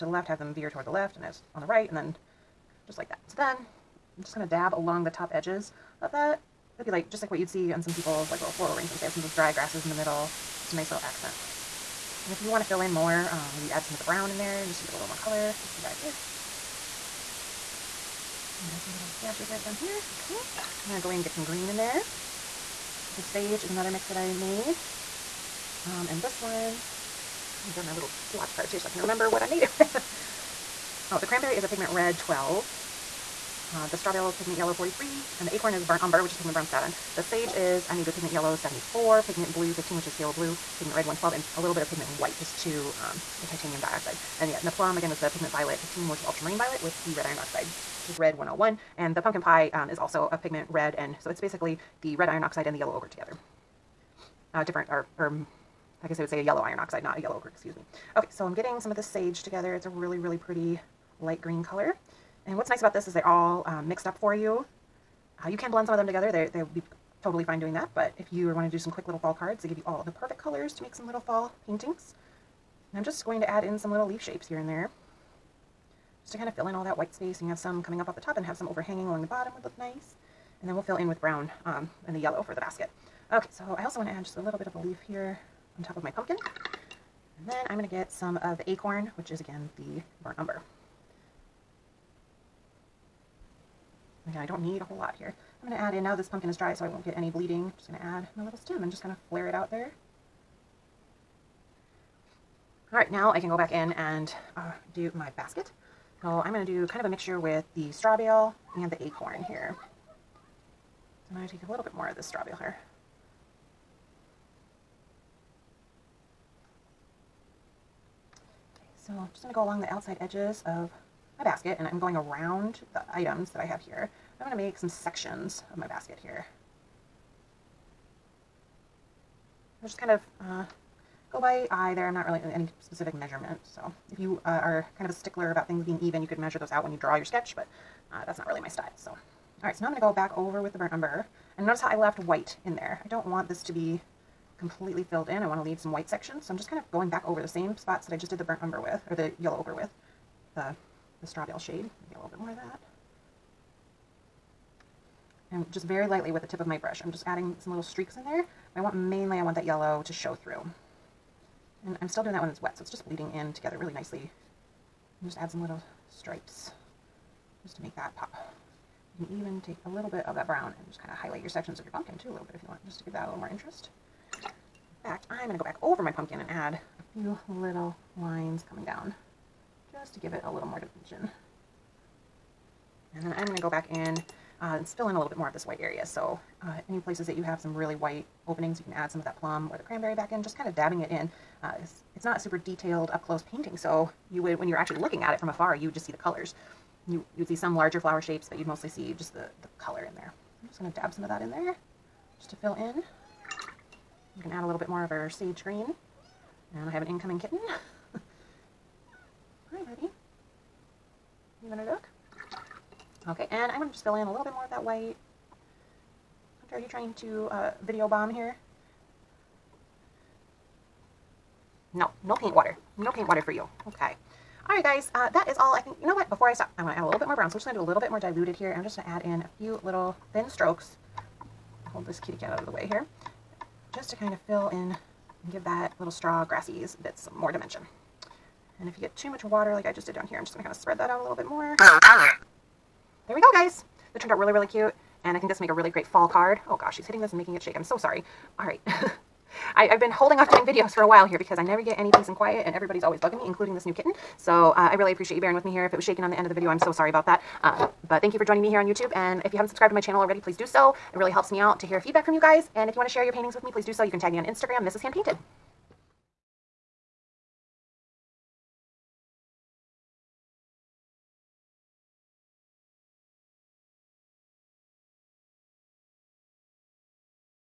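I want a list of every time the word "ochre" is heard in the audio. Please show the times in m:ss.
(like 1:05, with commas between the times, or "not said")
0:52, 0:57, 2:29.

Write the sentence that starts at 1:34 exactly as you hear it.
Again, I don't need a whole lot here.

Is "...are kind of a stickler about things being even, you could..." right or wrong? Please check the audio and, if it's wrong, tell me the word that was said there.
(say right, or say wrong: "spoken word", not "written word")
right.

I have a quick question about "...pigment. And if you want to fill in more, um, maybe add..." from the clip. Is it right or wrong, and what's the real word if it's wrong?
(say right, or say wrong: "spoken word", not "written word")
wrong: "accent", not "pigment".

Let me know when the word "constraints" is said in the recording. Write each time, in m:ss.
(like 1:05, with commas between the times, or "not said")
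not said.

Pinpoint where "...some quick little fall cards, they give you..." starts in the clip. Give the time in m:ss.
1:08.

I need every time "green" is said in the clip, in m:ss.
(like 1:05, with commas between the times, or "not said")
0:21, 1:01, 3:25.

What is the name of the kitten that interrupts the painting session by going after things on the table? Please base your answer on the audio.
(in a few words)
Hunter.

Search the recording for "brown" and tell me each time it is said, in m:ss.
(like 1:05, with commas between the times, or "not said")
0:14, 0:36, 1:21, 2:50, 3:47.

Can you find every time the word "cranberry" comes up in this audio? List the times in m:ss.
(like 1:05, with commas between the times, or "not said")
0:31, 3:09.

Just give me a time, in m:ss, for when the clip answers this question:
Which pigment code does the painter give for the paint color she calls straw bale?
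0:34.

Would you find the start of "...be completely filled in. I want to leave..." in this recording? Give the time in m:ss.
2:23.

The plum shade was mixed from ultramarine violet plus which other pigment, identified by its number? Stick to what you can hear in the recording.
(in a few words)
Red 101.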